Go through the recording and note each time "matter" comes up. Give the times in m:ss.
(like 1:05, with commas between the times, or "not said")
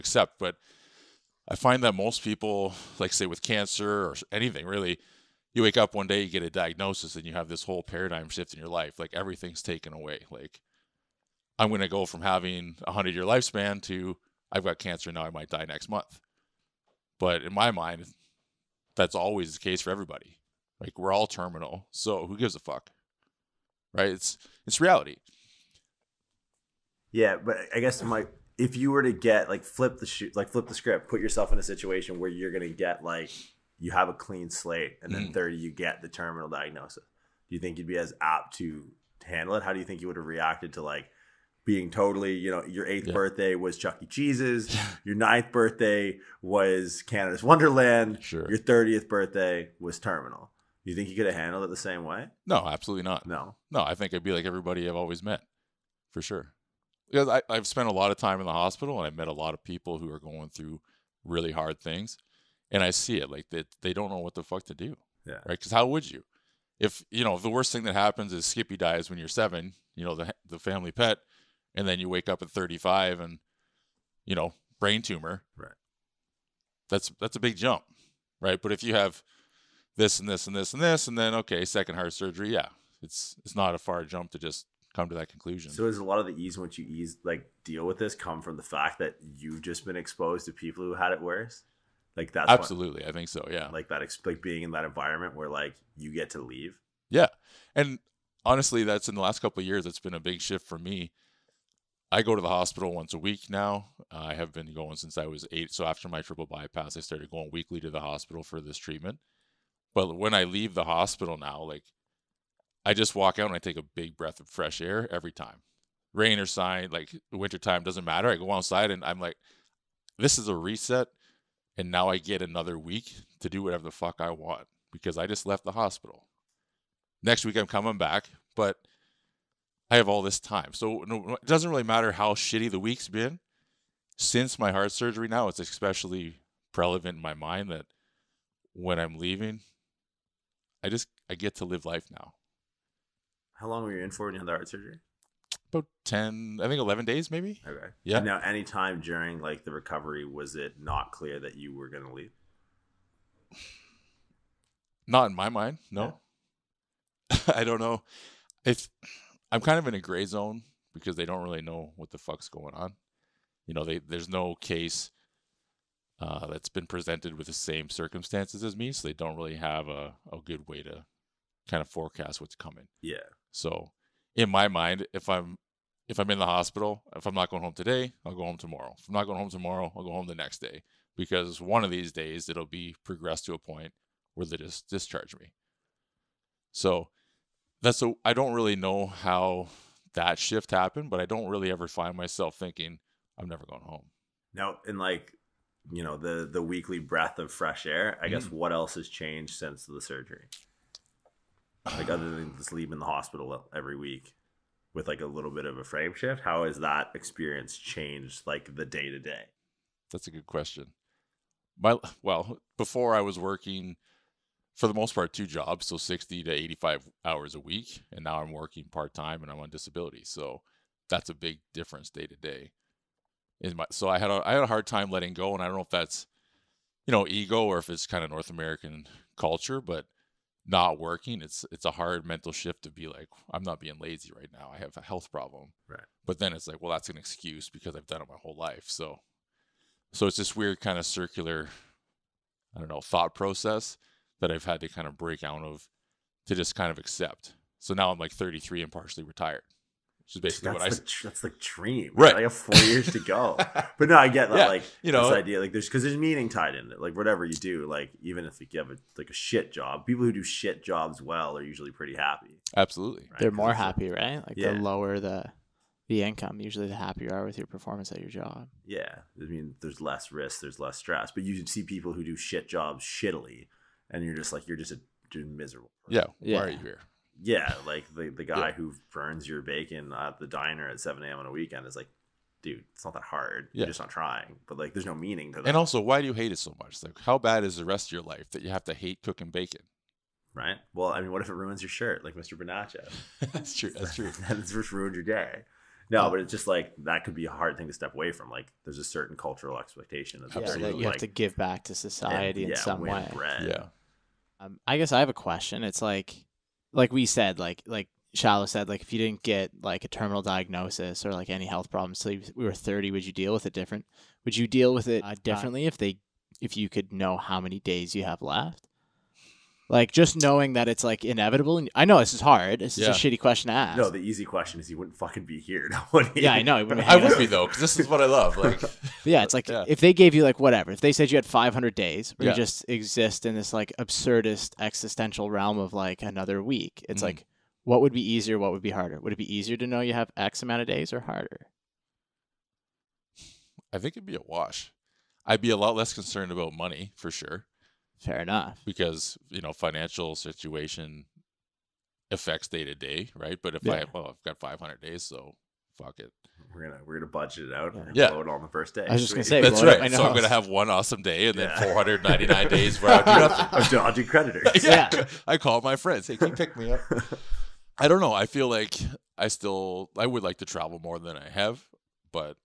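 1:58, 2:11.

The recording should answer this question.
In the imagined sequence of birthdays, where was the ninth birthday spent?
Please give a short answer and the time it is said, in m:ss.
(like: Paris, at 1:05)
Canada's Wonderland, at 0:47.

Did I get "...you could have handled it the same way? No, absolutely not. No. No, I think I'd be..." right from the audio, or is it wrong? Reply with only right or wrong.
right.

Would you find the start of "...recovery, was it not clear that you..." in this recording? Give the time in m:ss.
2:29.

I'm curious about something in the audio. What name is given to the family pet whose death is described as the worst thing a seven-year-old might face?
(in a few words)
Skippy.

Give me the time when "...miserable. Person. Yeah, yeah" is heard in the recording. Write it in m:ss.
4:35.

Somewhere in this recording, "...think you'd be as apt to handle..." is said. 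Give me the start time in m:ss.
0:37.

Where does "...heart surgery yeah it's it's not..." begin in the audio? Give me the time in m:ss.
1:21.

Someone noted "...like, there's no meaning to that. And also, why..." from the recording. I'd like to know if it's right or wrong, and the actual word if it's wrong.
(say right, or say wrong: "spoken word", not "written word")
right.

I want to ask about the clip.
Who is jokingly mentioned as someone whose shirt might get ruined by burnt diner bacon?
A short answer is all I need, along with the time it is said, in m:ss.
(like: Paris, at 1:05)
Mr. Bonaccio, at 4:52.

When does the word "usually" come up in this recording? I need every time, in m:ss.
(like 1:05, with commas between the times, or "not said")
4:21, 4:26.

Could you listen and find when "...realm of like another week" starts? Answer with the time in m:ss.
5:35.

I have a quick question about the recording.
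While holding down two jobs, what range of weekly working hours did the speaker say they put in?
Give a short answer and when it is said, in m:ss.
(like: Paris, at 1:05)
60 to 85, at 3:35.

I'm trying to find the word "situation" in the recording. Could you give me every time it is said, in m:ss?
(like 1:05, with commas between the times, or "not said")
0:31, 5:50.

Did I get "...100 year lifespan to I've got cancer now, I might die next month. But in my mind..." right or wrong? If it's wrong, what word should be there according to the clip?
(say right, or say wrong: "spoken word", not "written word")
right.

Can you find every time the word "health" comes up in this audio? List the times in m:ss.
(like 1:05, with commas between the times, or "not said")
3:55, 5:11.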